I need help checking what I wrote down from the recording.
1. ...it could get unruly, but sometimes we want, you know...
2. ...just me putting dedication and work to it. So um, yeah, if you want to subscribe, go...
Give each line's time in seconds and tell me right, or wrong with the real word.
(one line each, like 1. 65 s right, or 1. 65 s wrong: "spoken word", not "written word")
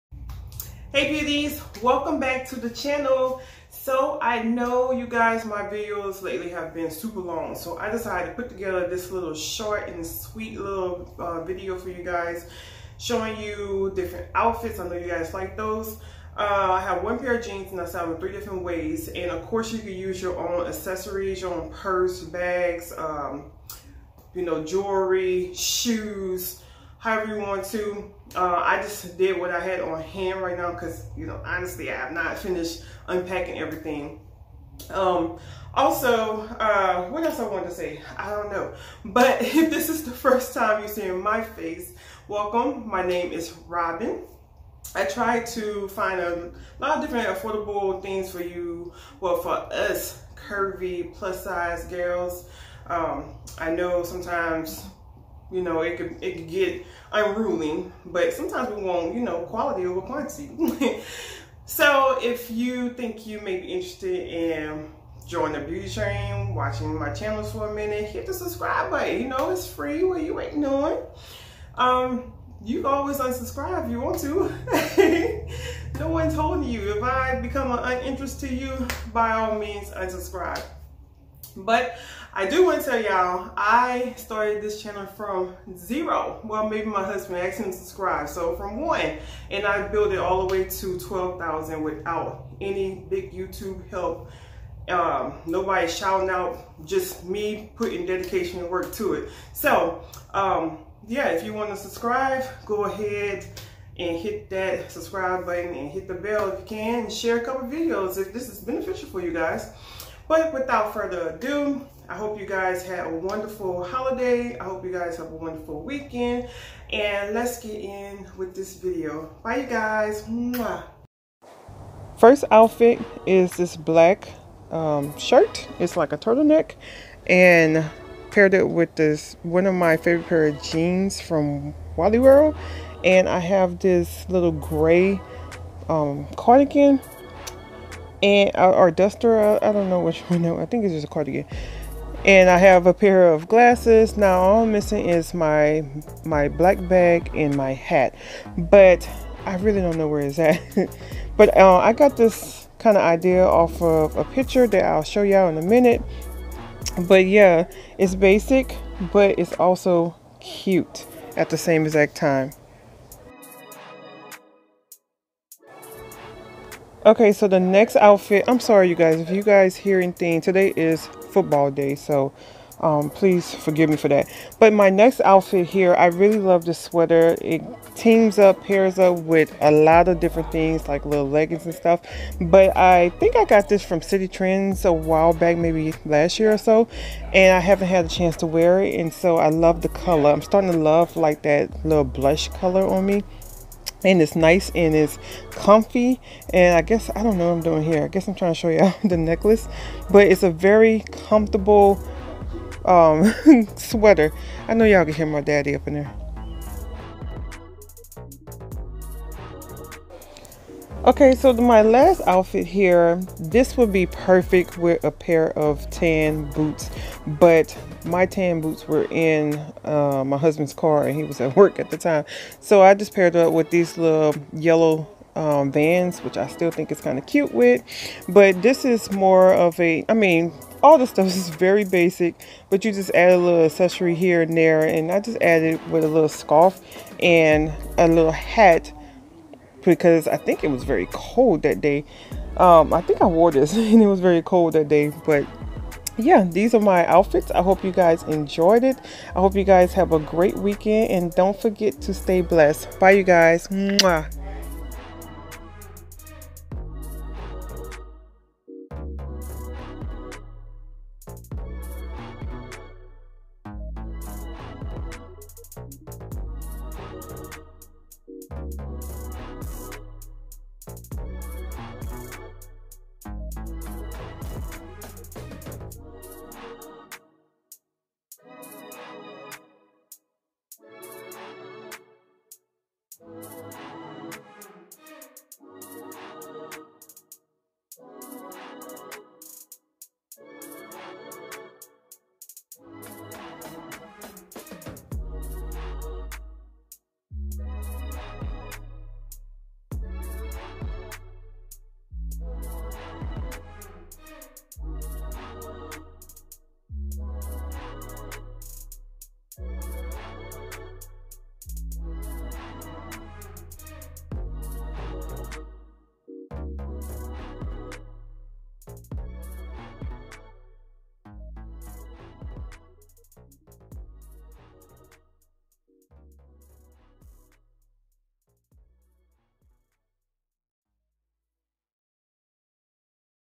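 1. 56 s right
2. 96 s right.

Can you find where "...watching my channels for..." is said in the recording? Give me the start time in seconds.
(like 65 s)
66 s.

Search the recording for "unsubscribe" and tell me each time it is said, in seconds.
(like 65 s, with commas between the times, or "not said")
73 s, 79 s.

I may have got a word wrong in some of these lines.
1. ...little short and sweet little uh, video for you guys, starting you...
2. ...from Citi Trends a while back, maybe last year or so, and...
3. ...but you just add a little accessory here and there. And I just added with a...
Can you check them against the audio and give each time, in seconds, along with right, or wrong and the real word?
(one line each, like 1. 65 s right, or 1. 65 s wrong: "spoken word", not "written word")
1. 9 s wrong: "showing", not "starting"
2. 183 s right
3. 232 s right.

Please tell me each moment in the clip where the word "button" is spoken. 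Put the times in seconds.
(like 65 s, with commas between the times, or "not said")
68 s, 105 s.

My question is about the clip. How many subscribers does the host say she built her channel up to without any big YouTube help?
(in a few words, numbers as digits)
12,000.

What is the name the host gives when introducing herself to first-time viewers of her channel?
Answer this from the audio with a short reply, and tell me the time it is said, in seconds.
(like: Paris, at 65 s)
Robin, at 43 s.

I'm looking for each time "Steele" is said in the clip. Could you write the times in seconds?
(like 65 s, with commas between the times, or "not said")
not said.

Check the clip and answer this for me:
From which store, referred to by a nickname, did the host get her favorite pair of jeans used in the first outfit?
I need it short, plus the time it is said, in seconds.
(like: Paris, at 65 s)
Wally World, at 131 s.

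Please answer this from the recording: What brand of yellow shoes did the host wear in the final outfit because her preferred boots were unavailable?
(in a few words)
Vans.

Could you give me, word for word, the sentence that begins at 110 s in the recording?
But without further ado, I hope you guys had a wonderful holiday.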